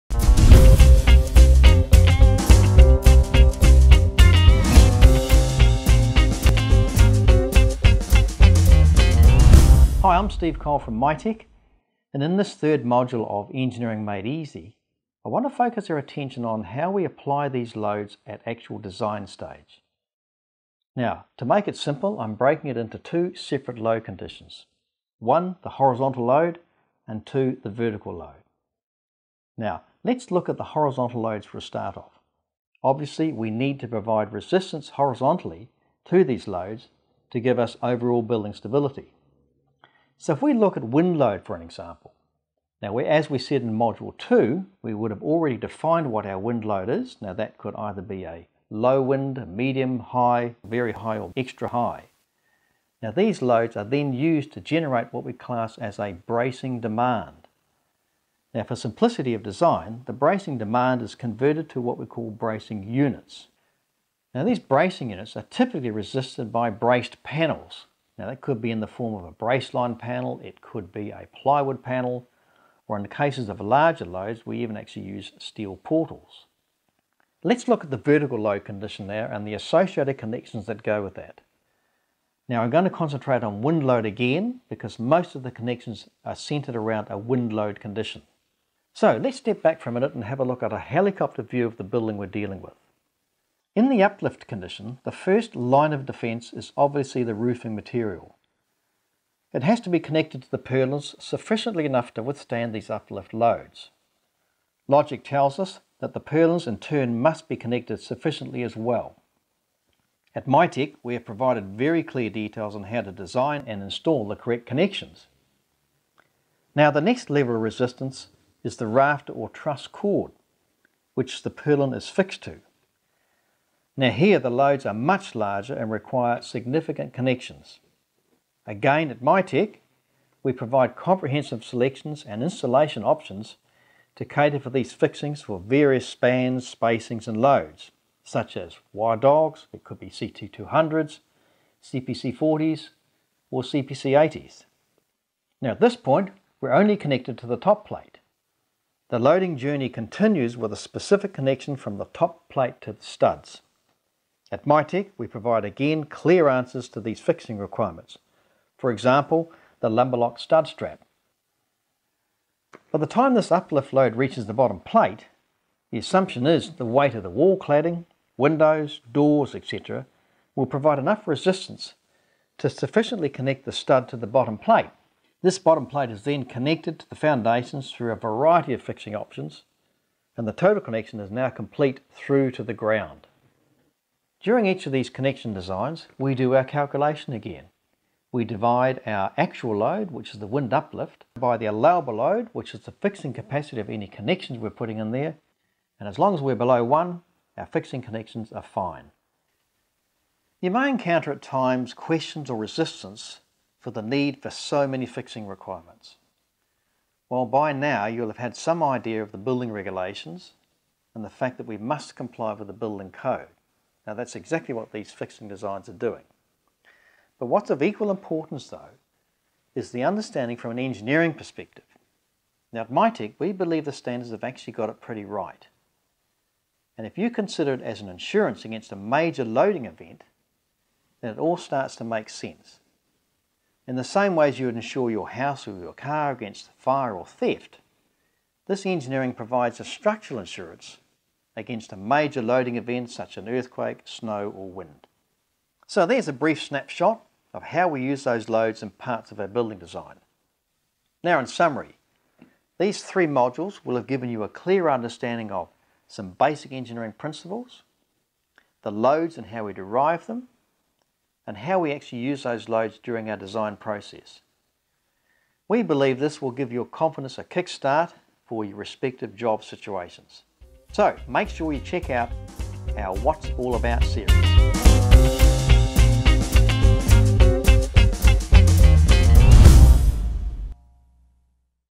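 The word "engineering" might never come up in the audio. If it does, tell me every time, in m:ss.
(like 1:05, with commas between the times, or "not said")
0:13, 3:40, 3:58, 4:16.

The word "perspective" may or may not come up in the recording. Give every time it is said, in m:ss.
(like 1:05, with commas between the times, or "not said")
3:41.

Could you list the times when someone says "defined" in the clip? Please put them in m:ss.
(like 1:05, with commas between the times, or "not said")
0:45.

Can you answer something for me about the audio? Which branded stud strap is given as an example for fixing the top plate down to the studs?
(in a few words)
Lumberlok.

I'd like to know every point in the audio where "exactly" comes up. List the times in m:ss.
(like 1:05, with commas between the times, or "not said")
3:34.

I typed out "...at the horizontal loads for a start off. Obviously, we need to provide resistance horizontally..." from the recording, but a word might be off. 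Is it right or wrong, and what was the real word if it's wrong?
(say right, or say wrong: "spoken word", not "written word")
right.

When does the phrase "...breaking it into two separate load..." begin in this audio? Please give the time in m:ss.
0:22.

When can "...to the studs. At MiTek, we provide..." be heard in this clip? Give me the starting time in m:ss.
2:32.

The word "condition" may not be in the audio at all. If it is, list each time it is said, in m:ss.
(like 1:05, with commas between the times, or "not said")
0:24, 1:18, 1:27, 1:34.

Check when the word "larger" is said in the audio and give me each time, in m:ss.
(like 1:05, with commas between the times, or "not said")
1:13, 2:05.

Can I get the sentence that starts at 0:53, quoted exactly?
Now these loads are then used to generate what we class as a bracing demand.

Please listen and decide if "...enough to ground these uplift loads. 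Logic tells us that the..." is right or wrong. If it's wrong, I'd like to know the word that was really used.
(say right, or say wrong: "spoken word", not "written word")
wrong: "withstand", not "ground".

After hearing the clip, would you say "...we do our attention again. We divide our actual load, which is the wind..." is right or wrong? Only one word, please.
wrong.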